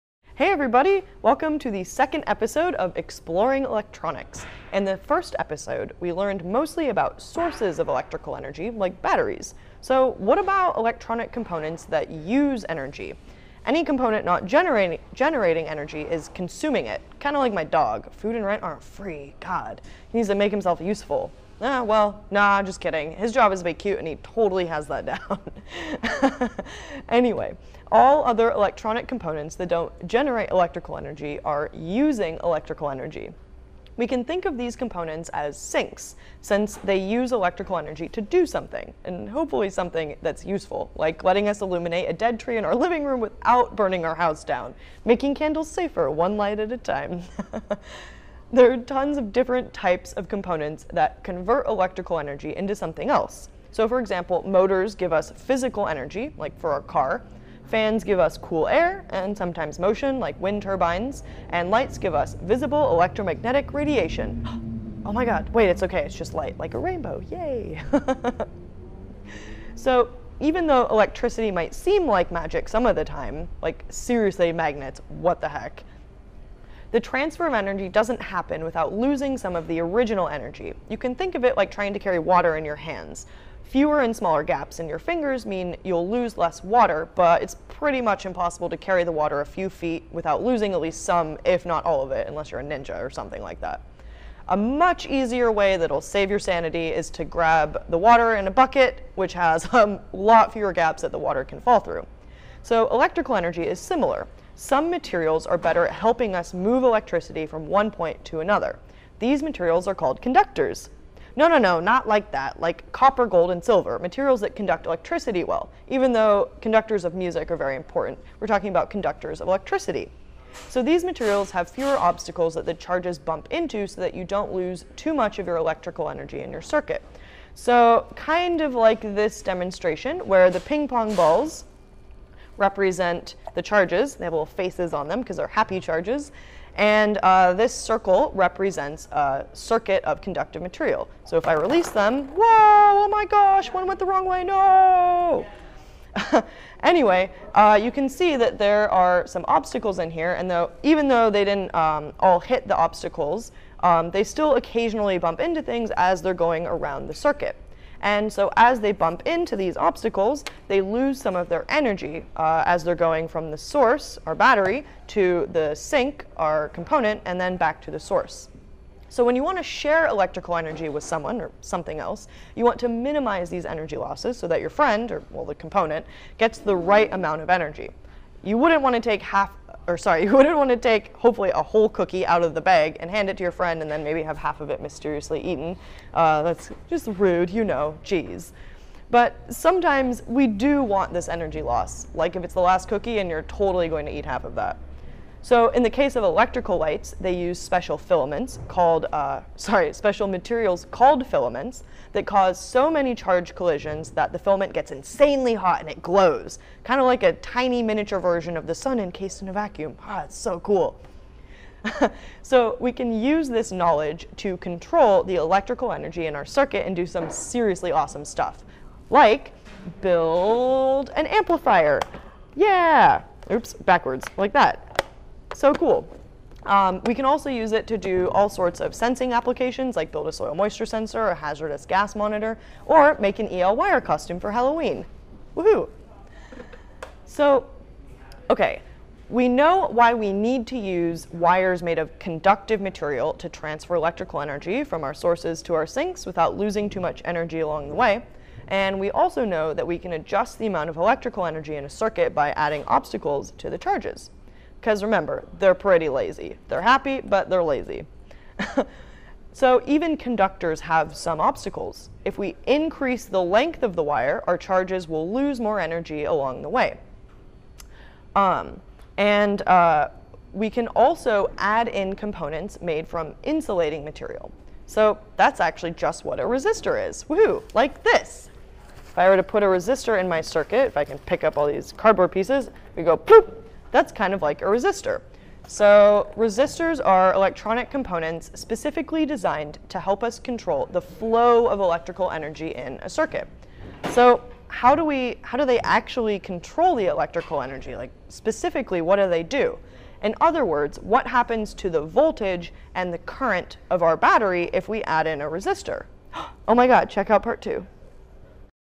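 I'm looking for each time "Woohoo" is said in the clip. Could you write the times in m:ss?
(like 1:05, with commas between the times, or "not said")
3:55, 4:37.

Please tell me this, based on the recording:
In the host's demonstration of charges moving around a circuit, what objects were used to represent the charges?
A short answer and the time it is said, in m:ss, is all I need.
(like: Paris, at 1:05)
ping pong balls, at 2:10.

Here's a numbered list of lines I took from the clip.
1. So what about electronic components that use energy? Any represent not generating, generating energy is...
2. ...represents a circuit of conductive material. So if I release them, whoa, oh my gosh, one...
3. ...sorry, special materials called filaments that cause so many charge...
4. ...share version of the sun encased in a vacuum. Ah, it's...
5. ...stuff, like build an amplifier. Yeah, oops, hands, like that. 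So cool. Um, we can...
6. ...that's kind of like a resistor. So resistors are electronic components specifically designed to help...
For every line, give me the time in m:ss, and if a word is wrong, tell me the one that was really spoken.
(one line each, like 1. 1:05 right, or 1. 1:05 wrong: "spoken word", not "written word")
1. 0:09 wrong: "component", not "represent"
2. 2:18 right
3. 3:19 right
4. 3:27 wrong: "miniature", not "share"
5. 3:38 wrong: "backwards", not "hands"
6. 4:43 right.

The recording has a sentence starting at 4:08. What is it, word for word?
And we also know that we can adjust the amount of electrical energy in a circuit by adding obstacles to the charges.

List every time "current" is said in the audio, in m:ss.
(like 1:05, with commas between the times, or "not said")
5:03.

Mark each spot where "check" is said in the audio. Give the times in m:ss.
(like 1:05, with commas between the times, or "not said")
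5:07.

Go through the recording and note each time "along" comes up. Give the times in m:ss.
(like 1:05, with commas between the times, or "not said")
4:07, 4:26.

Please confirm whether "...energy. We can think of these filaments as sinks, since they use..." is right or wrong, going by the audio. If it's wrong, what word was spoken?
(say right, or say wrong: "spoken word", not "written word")
wrong: "components", not "filaments".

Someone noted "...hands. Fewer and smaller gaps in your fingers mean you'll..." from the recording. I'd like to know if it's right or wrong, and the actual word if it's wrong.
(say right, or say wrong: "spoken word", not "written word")
right.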